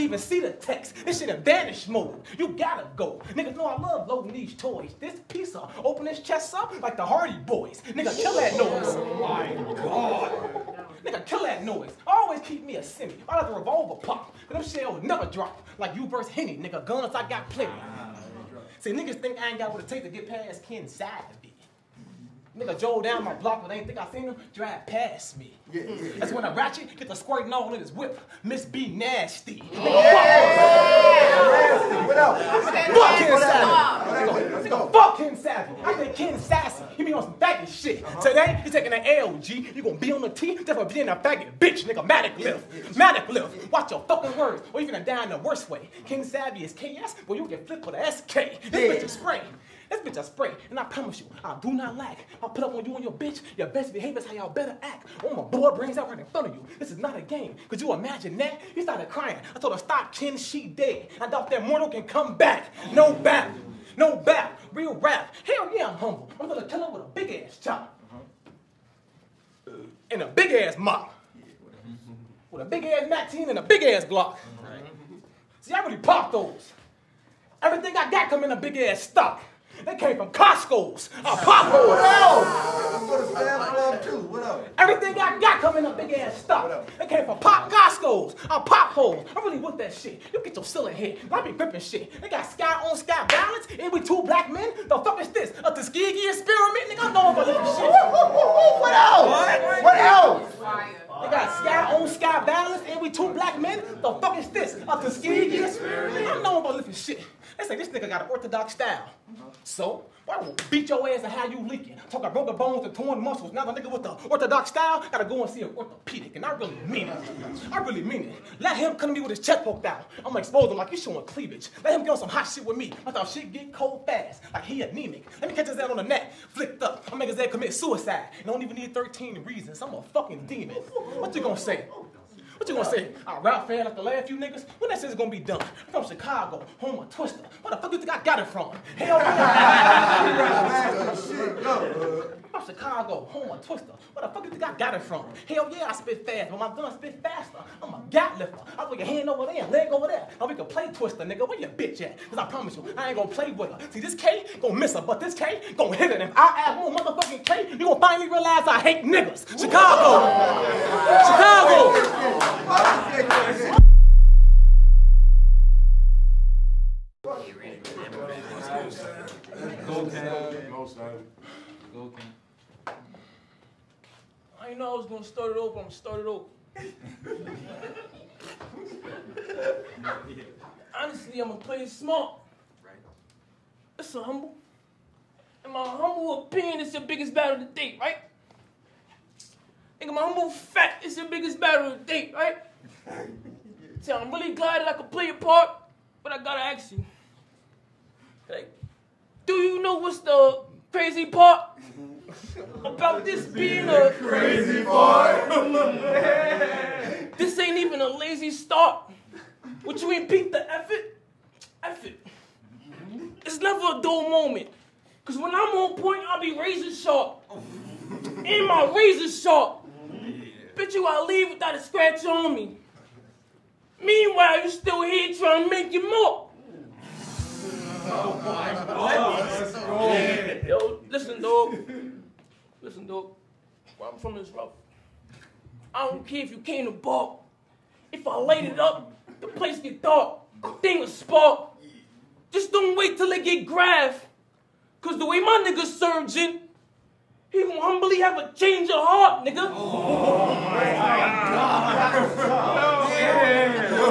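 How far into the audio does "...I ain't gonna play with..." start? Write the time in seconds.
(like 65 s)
152 s.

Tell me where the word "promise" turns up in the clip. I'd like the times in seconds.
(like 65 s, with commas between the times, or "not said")
50 s, 152 s.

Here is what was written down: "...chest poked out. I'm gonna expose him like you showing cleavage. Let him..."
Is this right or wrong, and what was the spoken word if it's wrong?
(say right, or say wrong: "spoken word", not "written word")
right.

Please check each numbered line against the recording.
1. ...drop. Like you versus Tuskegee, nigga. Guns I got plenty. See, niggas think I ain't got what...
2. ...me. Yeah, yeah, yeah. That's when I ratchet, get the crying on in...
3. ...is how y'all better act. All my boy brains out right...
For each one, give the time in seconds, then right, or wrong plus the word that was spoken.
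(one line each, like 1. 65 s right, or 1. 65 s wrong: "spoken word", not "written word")
1. 15 s wrong: "Henny", not "Tuskegee"
2. 25 s wrong: "squirting", not "crying"
3. 54 s right.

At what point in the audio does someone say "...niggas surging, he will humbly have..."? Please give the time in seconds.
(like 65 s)
245 s.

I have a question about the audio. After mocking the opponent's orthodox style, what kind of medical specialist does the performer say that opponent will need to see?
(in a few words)
Orthopedic.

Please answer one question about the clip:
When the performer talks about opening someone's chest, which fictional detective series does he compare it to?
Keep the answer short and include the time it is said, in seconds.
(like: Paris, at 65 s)
The Hardy Boys, at 7 s.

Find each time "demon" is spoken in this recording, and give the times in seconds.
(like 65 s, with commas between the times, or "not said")
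130 s.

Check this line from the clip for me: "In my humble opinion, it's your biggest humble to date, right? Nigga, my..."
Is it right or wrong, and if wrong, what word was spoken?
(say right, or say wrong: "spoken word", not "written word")
wrong: "battle", not "humble".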